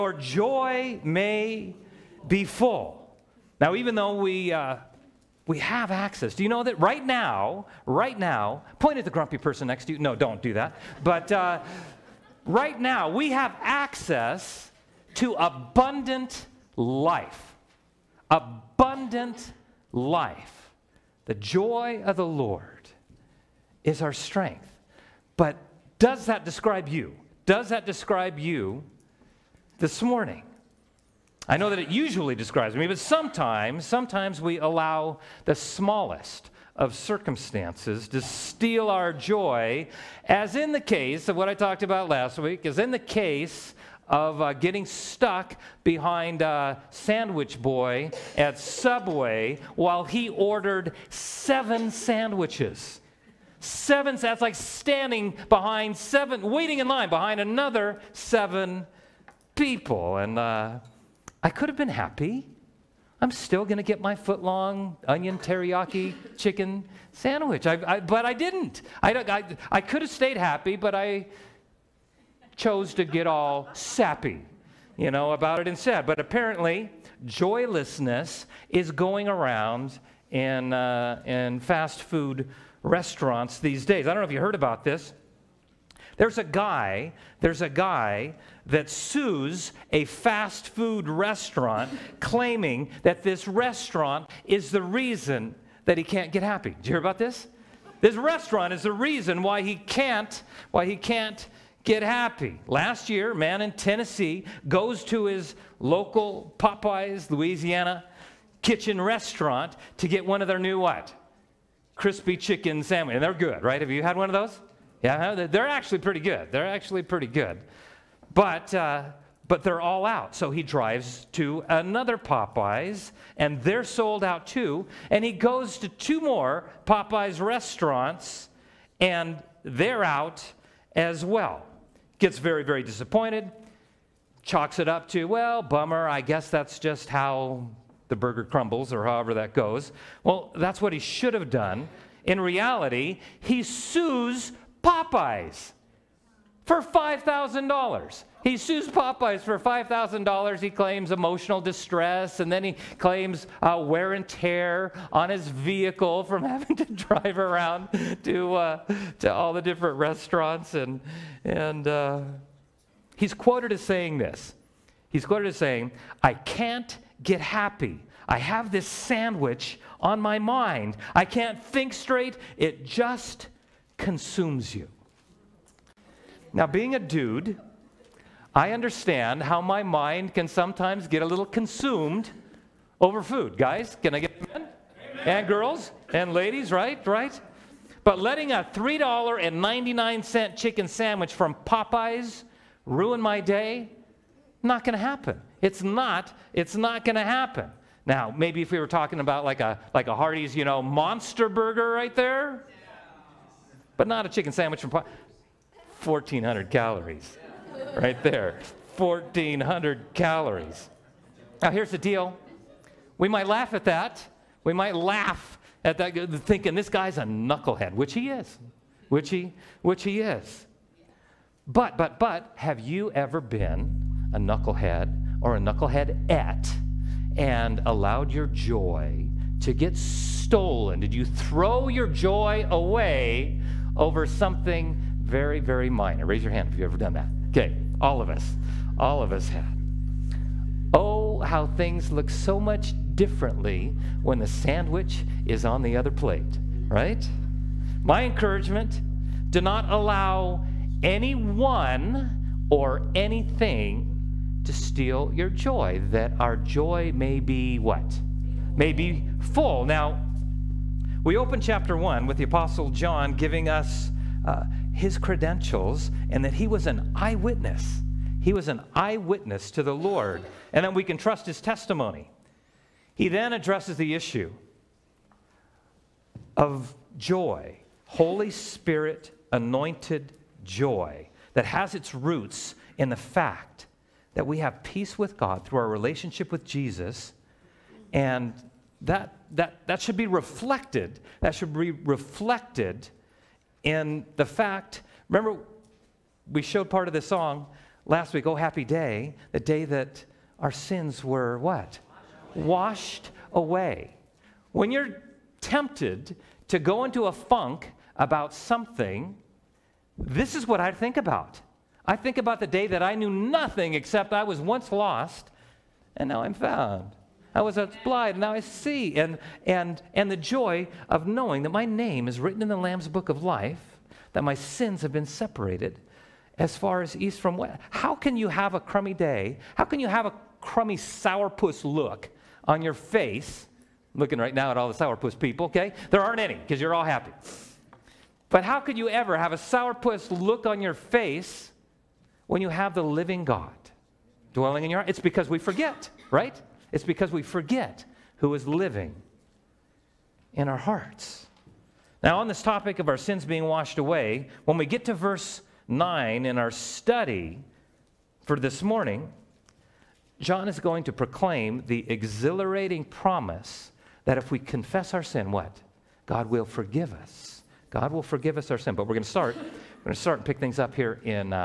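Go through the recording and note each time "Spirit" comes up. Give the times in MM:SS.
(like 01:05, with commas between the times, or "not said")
04:38.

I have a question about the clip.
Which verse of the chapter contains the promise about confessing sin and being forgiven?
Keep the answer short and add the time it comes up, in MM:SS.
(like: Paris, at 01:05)
Verse 9, at 05:55.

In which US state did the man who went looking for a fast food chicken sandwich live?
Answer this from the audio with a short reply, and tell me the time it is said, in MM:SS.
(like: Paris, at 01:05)
Tennessee, at 01:43.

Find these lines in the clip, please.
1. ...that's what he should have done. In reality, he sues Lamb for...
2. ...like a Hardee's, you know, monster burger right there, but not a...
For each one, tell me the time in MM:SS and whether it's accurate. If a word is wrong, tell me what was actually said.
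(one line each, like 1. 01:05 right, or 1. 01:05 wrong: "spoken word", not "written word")
1. 02:20 wrong: "Popeyes", not "Lamb"
2. 03:19 right.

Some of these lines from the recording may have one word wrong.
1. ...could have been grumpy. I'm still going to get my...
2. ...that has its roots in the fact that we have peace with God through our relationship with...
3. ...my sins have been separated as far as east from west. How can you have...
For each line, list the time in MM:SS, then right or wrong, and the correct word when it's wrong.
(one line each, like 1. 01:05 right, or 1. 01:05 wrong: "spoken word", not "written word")
1. 01:01 wrong: "happy", not "grumpy"
2. 04:41 right
3. 05:24 right.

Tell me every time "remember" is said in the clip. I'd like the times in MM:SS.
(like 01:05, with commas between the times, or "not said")
04:55.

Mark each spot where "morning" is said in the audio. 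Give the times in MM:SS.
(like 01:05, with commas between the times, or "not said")
00:30, 05:58.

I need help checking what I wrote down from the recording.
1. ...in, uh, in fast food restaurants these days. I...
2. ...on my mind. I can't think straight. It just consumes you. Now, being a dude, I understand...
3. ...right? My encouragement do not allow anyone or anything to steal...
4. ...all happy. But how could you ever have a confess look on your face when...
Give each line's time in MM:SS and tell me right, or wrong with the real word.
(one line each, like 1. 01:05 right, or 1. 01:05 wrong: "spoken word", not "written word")
1. 01:20 right
2. 02:49 right
3. 04:06 right
4. 05:36 wrong: "sourpuss", not "confess".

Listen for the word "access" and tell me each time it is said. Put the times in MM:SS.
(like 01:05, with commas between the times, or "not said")
00:05, 00:13.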